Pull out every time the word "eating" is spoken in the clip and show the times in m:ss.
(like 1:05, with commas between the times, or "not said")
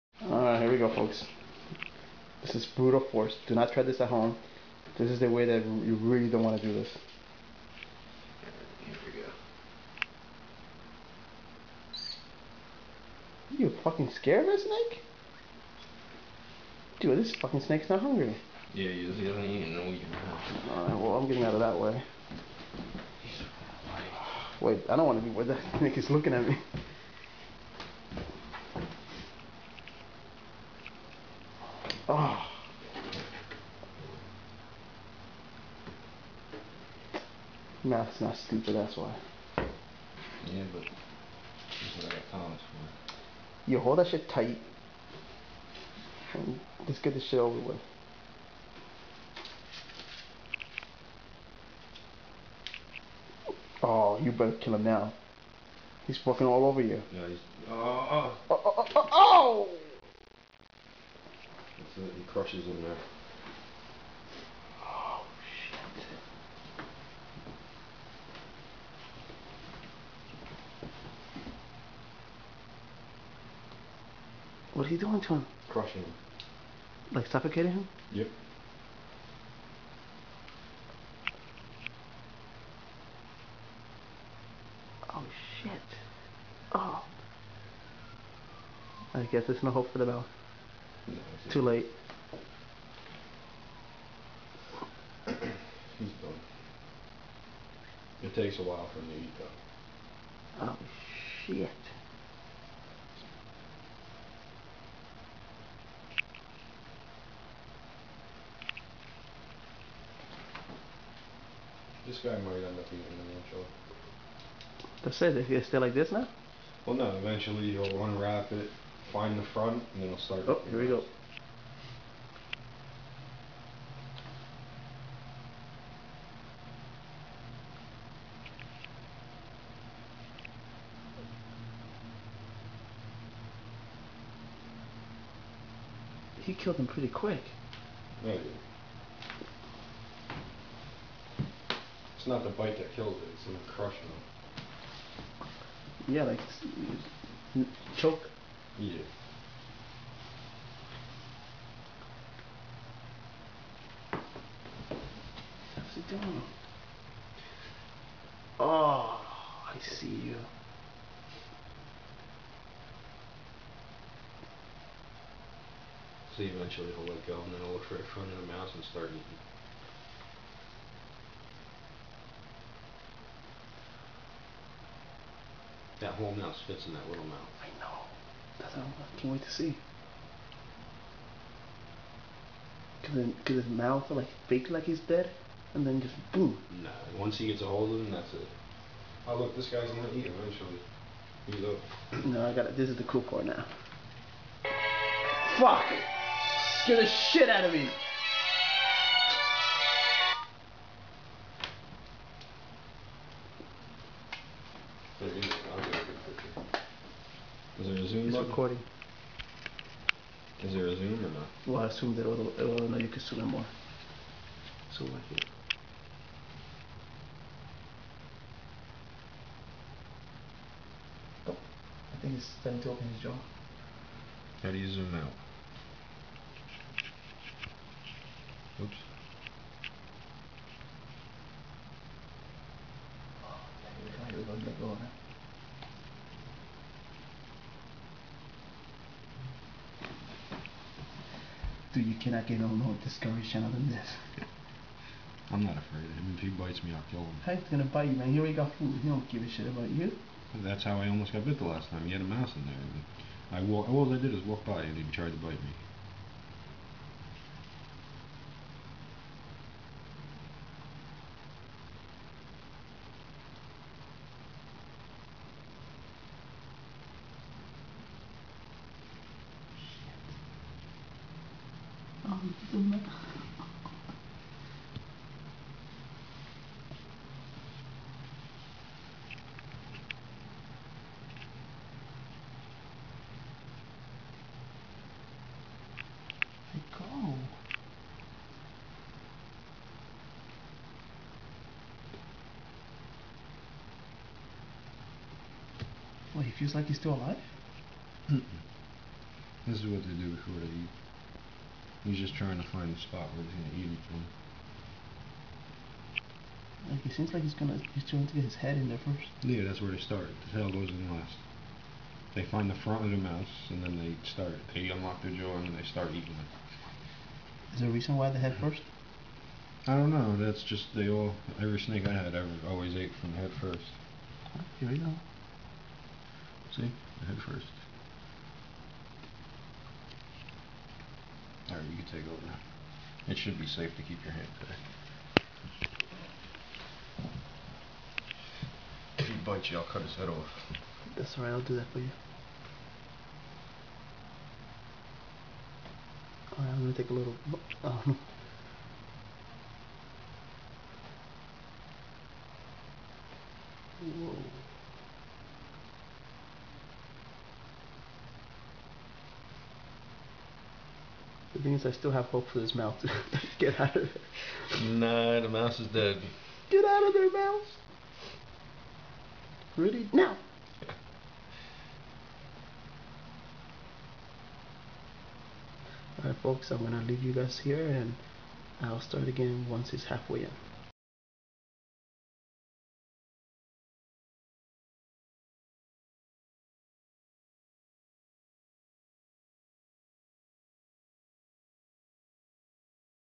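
1:52, 2:49, 5:16.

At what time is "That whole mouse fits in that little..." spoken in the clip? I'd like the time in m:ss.
2:56.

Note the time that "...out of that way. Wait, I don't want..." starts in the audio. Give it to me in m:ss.
0:21.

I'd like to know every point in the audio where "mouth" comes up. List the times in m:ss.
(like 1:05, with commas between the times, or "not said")
2:57, 3:03.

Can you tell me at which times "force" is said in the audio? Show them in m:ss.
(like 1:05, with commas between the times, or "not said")
0:03.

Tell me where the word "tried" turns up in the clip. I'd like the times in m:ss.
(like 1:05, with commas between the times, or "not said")
4:15.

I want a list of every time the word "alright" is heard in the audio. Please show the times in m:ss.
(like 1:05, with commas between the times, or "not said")
0:20, 5:41, 5:46, 6:16.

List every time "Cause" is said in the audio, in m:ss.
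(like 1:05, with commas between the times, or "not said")
3:03.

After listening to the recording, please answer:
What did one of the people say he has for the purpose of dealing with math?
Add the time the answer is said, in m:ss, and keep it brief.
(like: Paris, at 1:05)
college, at 0:42.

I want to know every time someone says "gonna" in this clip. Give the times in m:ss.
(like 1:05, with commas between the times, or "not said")
3:09, 4:07, 5:03, 5:07, 5:46.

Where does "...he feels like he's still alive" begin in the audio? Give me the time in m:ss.
4:56.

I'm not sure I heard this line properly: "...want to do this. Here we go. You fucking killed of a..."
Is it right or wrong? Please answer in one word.
wrong.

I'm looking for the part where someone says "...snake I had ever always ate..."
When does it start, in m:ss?
5:21.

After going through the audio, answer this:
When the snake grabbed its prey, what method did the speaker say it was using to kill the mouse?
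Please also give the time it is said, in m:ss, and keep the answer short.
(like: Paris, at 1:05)
Crushing him, at 1:15.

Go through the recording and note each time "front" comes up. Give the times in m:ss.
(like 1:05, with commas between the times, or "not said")
1:59, 2:48, 5:12.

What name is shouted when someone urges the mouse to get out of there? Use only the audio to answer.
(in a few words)
Rudy.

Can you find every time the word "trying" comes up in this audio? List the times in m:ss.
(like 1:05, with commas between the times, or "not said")
5:02, 5:08.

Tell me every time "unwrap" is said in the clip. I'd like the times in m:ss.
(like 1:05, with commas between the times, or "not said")
1:58.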